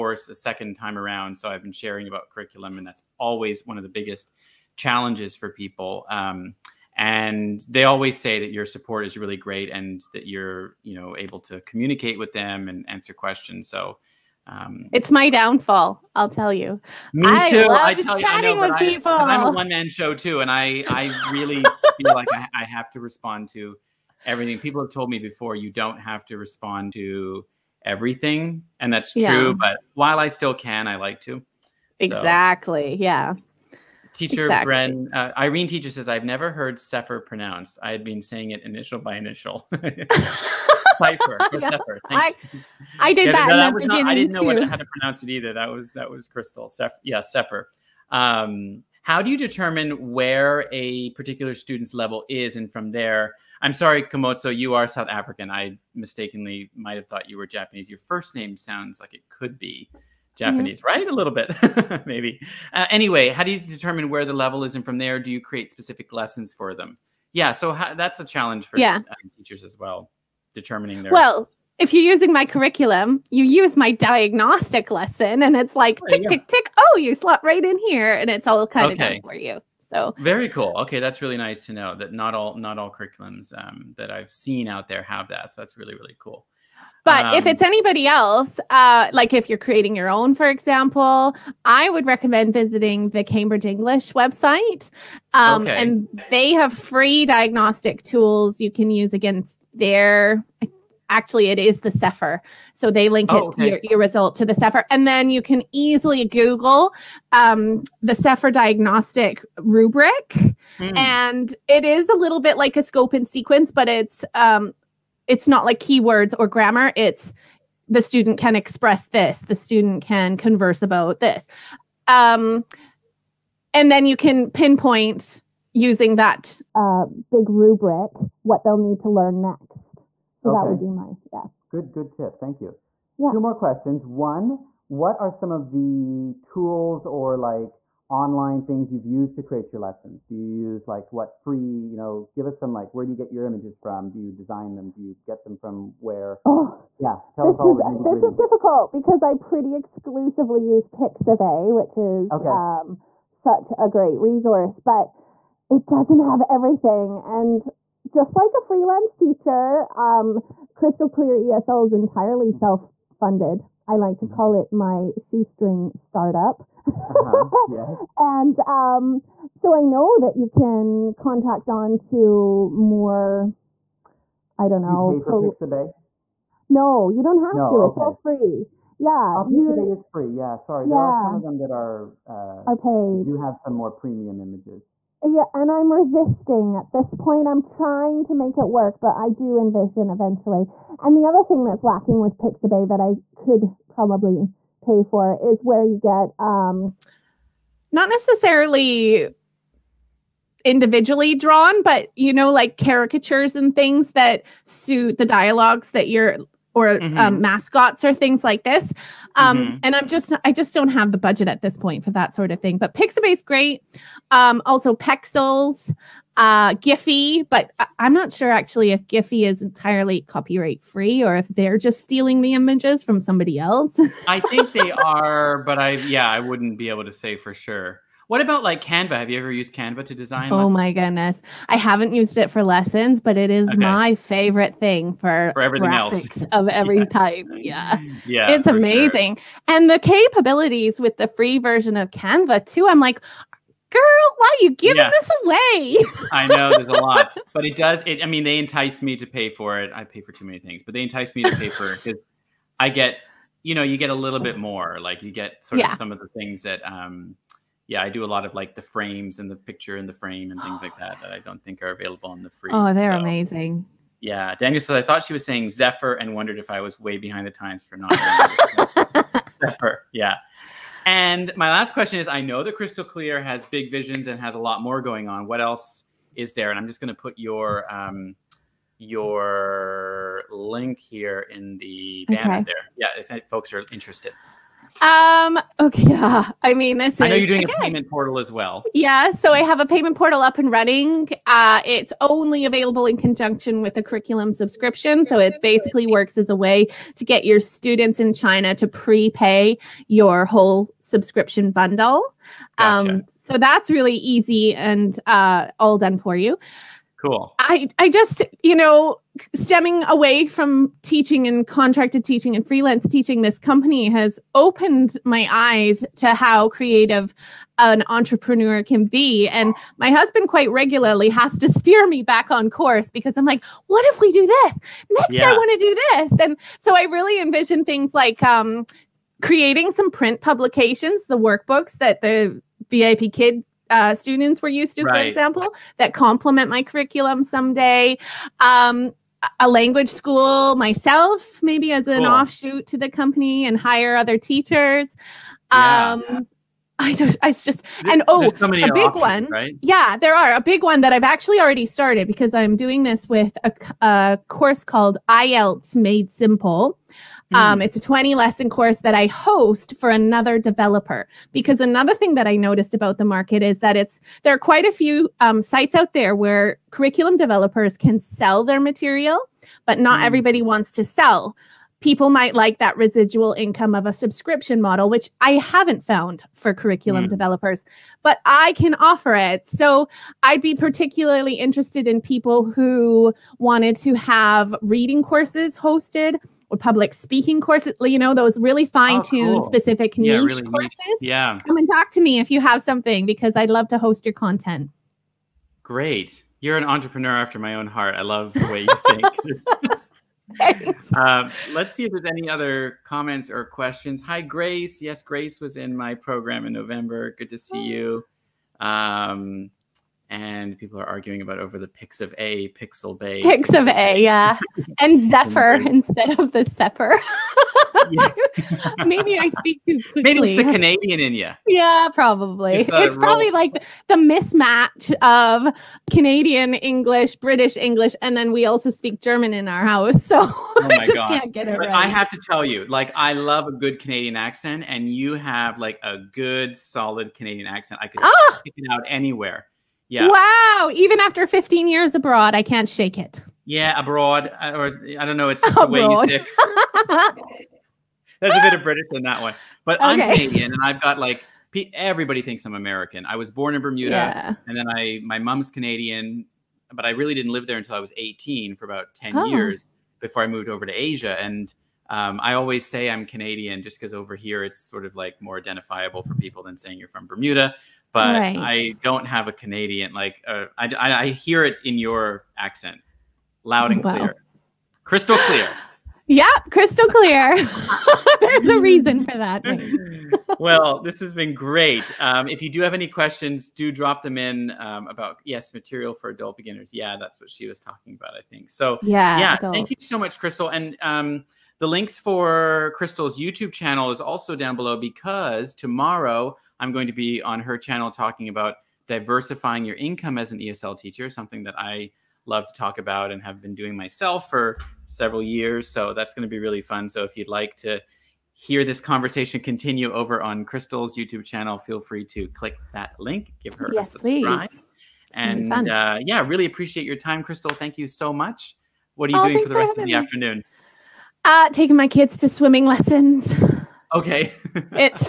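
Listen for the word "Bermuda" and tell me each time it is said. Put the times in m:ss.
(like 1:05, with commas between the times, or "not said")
7:33, 7:47.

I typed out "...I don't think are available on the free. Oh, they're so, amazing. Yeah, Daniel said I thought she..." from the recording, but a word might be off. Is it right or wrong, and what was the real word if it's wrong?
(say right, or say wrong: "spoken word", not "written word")
right.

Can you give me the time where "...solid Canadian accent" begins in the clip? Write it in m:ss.
7:16.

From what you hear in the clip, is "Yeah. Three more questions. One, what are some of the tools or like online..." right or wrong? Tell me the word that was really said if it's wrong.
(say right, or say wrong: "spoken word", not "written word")
wrong: "Two", not "Three".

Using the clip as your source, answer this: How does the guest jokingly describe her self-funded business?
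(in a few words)
shoestring startup.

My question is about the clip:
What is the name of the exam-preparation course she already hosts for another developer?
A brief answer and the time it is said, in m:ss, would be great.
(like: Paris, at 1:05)
IELTS Made Simple, at 5:55.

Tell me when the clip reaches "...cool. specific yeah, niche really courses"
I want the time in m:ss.
6:29.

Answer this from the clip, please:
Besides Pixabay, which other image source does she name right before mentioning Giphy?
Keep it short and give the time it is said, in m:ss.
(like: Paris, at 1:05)
Pexels, at 3:34.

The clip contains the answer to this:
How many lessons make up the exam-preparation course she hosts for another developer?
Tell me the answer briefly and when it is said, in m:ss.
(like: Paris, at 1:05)
20, at 5:57.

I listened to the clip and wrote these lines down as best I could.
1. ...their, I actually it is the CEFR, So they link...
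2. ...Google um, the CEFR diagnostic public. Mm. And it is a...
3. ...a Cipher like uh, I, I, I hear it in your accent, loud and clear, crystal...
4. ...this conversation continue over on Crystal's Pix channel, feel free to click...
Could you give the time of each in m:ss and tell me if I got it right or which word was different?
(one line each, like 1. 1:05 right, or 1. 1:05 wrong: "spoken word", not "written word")
1. 1:39 right
2. 1:46 wrong: "rubric", not "public"
3. 7:49 wrong: "Canadian", not "Cipher"
4. 8:28 wrong: "YouTube", not "Pix".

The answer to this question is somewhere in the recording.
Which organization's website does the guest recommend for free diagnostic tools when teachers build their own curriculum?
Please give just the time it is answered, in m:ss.
1:33.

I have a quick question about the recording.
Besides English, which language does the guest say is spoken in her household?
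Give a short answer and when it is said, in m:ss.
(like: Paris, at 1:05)
German, at 7:09.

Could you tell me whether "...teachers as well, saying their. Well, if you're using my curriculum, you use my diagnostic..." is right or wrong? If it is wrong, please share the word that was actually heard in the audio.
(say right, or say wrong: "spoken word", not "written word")
wrong: "determining", not "saying".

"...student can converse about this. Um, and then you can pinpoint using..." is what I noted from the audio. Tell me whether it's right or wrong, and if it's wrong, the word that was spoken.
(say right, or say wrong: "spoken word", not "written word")
right.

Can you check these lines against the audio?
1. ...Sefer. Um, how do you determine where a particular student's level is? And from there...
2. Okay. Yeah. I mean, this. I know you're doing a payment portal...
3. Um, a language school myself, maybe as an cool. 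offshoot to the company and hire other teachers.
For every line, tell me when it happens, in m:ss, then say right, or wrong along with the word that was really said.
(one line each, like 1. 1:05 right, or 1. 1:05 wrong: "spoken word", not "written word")
1. 0:47 right
2. 4:45 right
3. 5:38 right.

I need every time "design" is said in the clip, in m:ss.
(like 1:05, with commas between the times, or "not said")
2:24, 3:50.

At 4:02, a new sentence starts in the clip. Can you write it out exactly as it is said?
I'm like, girl, why are you giving yeah.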